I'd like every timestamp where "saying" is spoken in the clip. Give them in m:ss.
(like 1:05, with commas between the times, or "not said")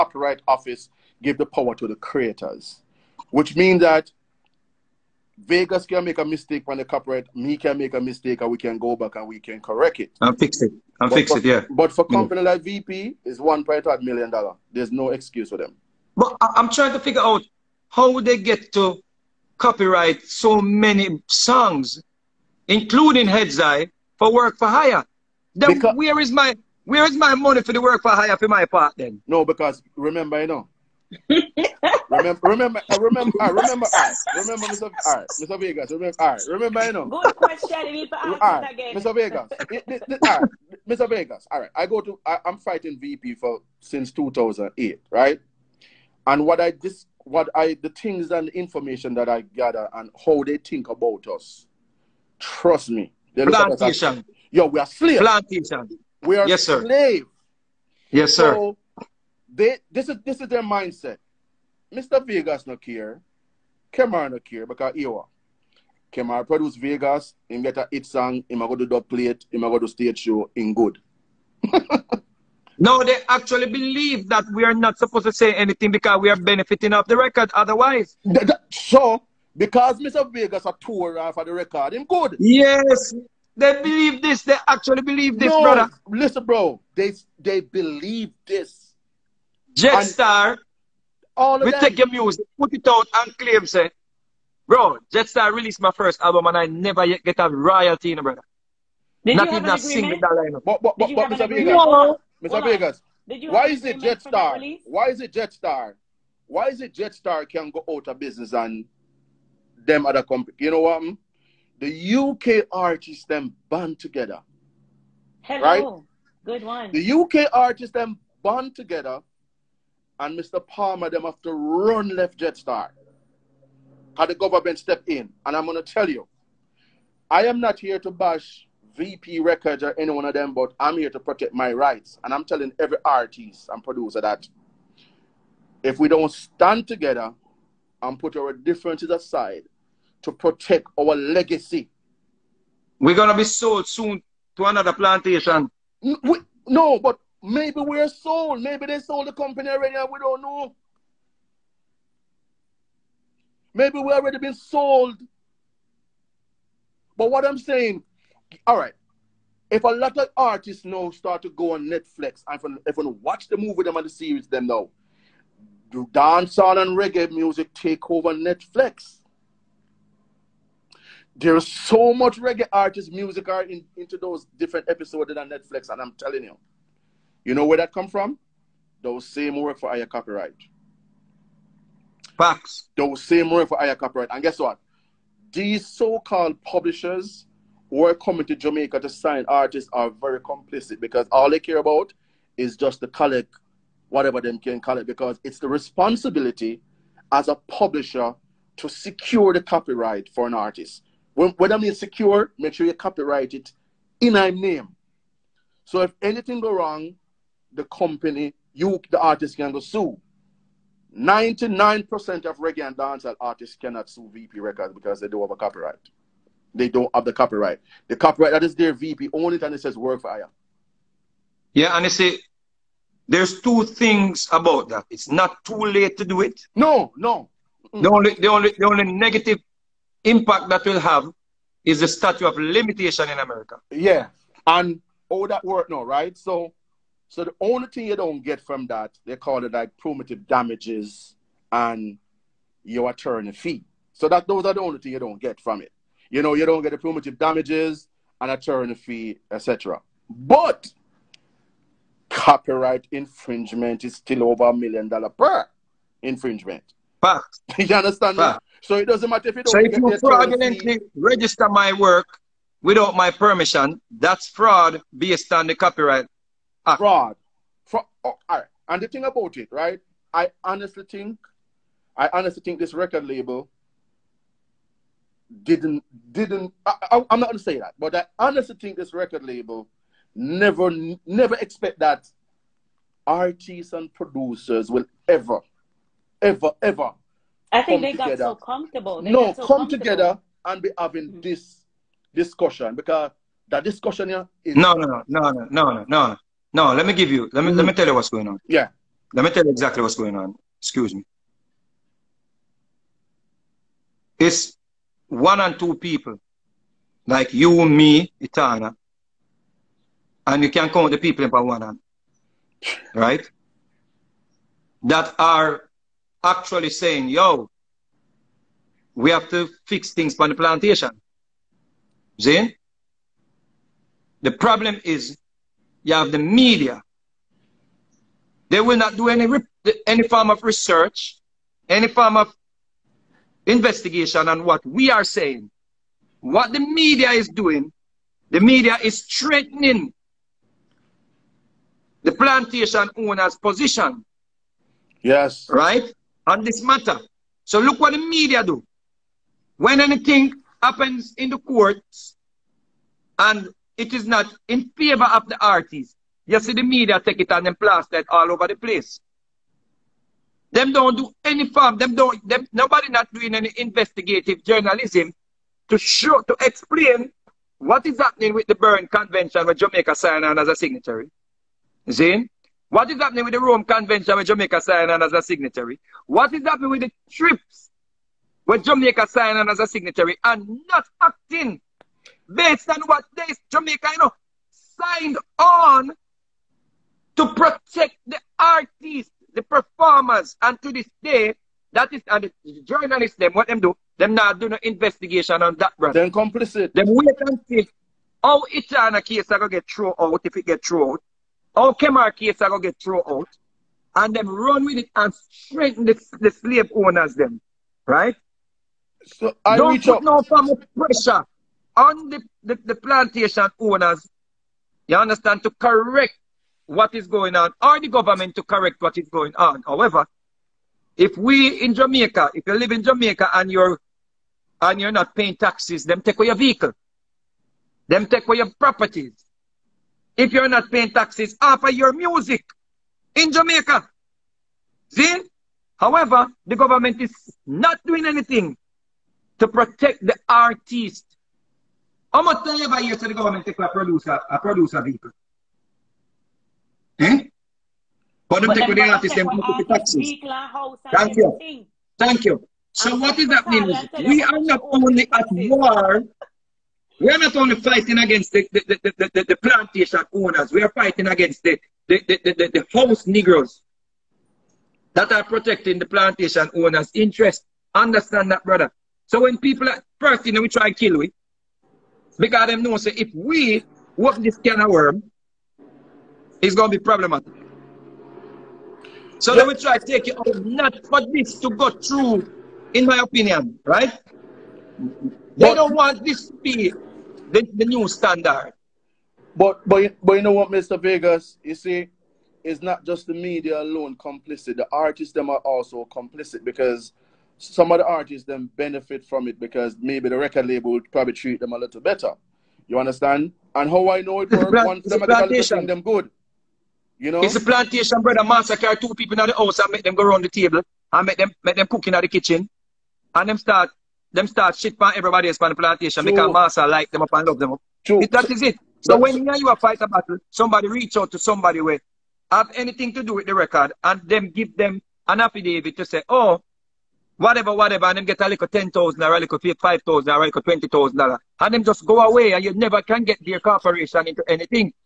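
2:37, 5:16, 5:35.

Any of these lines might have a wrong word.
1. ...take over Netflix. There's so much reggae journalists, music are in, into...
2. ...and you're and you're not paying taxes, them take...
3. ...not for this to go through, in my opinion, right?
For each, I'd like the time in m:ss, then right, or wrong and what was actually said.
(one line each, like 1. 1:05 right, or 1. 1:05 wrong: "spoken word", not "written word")
1. 2:47 wrong: "artists", not "journalists"
2. 7:03 right
3. 8:00 right.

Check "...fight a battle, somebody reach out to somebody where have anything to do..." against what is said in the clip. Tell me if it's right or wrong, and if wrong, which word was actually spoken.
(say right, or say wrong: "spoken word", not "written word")
right.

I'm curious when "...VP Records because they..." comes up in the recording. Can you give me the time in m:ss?
3:34.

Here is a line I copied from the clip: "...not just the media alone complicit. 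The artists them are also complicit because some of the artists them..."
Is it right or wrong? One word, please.
right.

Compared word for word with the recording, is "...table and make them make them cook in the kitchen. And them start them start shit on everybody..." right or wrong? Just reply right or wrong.
right.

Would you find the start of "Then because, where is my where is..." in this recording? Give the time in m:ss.
0:25.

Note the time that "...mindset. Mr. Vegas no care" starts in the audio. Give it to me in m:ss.
1:00.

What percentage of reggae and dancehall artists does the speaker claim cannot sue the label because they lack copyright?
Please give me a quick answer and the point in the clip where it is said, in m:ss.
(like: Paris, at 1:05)
99%, at 3:31.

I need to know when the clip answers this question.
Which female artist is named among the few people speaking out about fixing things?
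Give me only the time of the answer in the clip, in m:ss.
5:08.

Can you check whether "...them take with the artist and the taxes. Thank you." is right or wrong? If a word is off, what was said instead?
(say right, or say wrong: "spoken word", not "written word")
right.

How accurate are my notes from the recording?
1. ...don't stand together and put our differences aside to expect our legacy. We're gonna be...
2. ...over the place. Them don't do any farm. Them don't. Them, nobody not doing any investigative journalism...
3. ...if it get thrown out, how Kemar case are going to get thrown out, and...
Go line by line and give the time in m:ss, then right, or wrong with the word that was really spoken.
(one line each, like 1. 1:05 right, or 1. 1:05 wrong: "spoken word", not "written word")
1. 2:16 wrong: "protect", not "expect"
2. 5:58 right
3. 6:40 right.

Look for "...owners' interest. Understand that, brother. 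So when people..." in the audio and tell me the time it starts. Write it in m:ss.
7:46.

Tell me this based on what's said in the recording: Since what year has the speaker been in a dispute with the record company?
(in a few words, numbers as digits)
2008.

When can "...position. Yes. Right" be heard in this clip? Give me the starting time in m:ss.
5:43.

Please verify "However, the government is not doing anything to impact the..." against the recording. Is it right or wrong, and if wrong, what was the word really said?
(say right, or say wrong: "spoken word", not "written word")
wrong: "protect", not "impact".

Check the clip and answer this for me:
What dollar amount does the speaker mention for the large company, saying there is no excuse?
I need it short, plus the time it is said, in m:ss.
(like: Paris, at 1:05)
1.8 million dollars, at 0:13.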